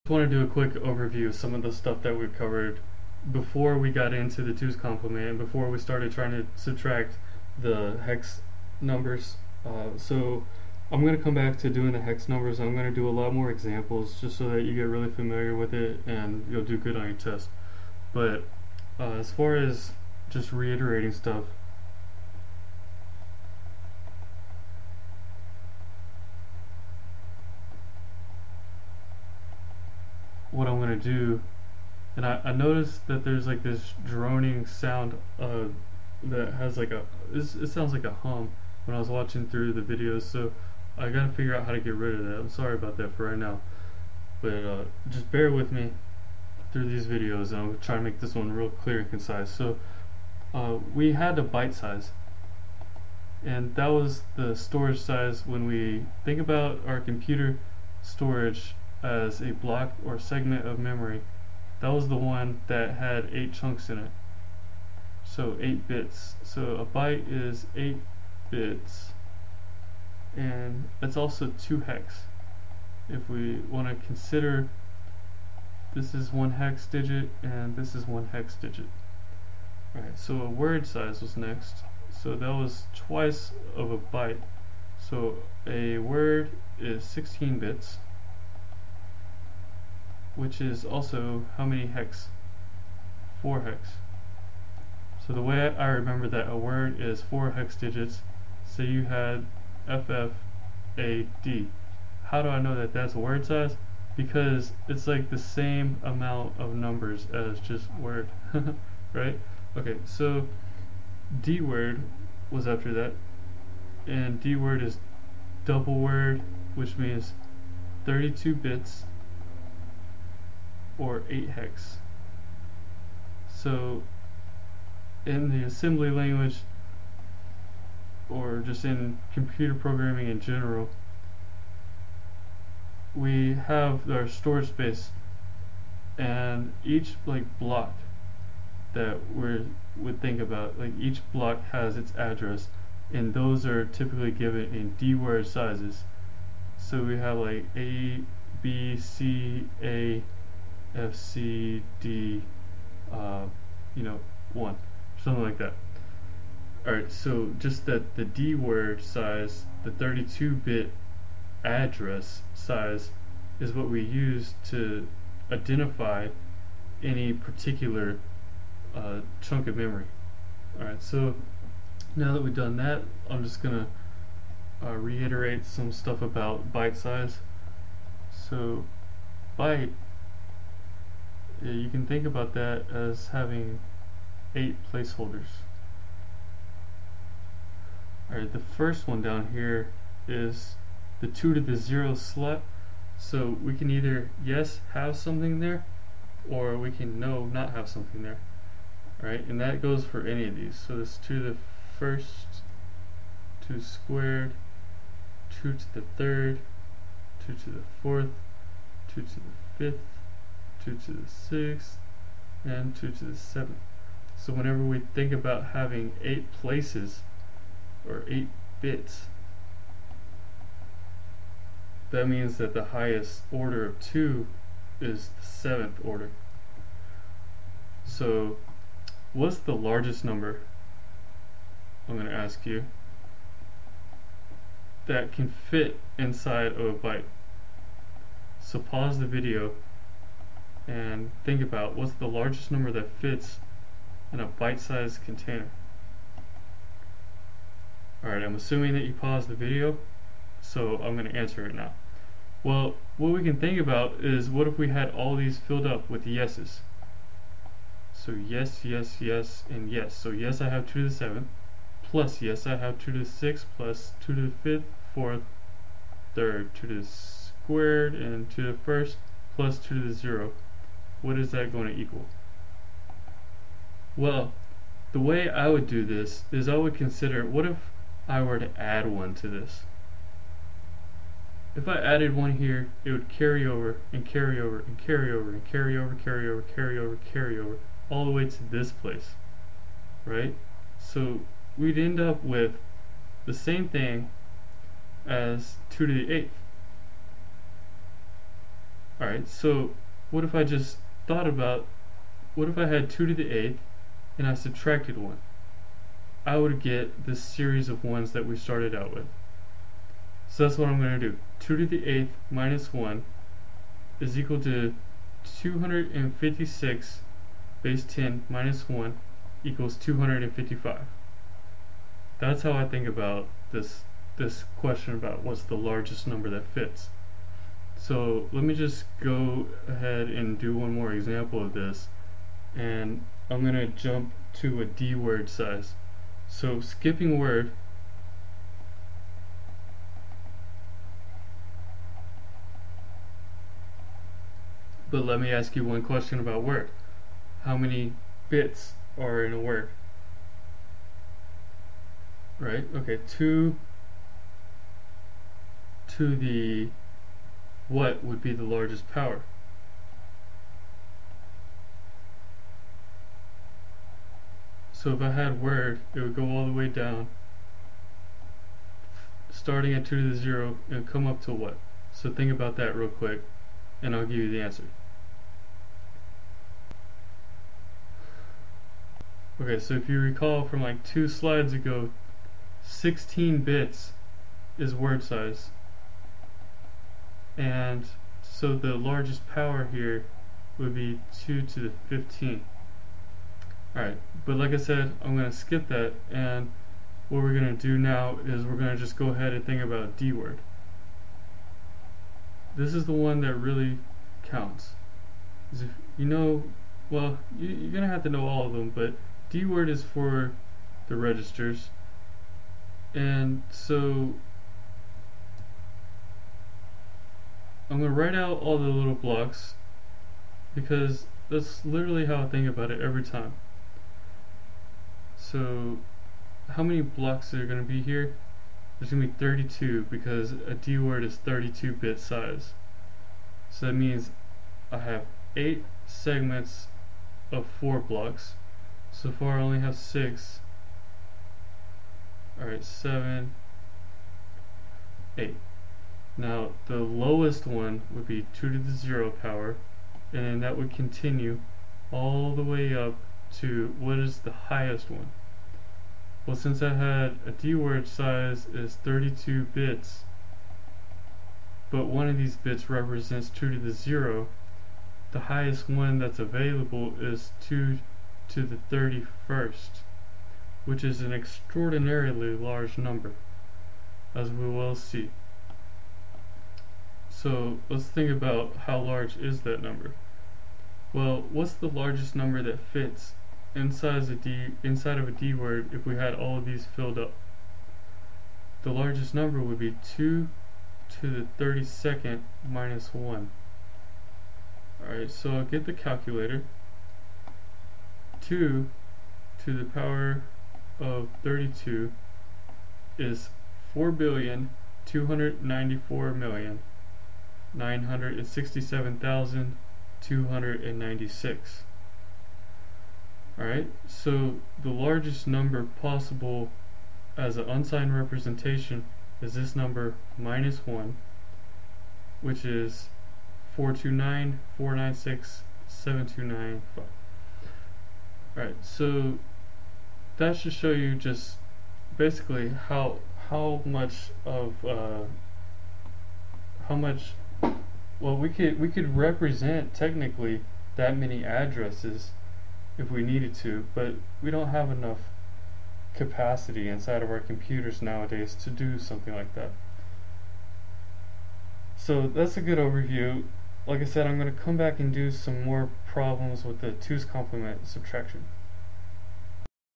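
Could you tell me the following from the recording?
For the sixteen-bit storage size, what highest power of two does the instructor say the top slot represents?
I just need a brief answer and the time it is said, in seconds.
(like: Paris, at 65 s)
2 to the 15, at 391 s.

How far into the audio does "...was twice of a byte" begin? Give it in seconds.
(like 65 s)
82 s.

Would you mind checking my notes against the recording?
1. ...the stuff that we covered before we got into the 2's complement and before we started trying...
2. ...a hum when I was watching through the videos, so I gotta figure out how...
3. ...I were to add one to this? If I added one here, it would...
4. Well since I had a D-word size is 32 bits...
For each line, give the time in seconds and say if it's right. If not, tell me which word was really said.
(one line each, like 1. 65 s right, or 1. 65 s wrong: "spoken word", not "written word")
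1. 1 s right
2. 38 s right
3. 278 s right
4. 456 s right.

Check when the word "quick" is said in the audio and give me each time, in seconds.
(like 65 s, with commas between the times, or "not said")
0 s, 373 s.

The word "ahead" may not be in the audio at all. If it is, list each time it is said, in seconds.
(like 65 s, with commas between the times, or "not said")
329 s, 399 s.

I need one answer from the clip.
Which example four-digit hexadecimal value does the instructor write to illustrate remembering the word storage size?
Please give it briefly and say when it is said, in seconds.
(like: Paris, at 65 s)
FFAD, at 99 s.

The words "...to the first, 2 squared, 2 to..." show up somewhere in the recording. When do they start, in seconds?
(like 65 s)
201 s.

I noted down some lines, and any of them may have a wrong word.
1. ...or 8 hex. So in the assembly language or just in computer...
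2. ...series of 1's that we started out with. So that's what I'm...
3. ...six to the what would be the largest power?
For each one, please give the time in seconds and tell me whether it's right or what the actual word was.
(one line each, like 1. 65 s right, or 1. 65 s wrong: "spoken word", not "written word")
1. 121 s right
2. 307 s right
3. 353 s wrong: "two", not "six".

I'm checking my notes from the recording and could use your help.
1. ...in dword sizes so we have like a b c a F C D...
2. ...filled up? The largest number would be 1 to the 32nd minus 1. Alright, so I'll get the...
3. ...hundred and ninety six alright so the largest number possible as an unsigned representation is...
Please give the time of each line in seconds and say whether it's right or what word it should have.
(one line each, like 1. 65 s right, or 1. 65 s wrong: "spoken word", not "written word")
1. 144 s right
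2. 486 s wrong: "2", not "1"
3. 510 s right.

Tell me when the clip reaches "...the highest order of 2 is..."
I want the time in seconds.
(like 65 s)
222 s.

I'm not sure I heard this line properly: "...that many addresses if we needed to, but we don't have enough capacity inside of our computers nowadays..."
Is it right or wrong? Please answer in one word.
right.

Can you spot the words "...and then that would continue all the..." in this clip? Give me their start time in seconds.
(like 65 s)
450 s.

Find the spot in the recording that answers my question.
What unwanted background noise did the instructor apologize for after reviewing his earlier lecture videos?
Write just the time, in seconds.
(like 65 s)
34 s.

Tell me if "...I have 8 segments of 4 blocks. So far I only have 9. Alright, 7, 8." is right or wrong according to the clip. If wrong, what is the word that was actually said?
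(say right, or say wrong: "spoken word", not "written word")
wrong: "6", not "9".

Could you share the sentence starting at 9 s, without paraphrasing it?
Uh, so I'm going to come back to doing the hex numbers.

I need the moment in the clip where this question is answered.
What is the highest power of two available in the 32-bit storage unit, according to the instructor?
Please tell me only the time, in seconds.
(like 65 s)
467 s.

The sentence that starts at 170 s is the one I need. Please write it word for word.
Alright, so now that we've done that, I'm just going to uh, reiterate some stuff about byte size.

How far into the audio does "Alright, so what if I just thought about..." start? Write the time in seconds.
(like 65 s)
299 s.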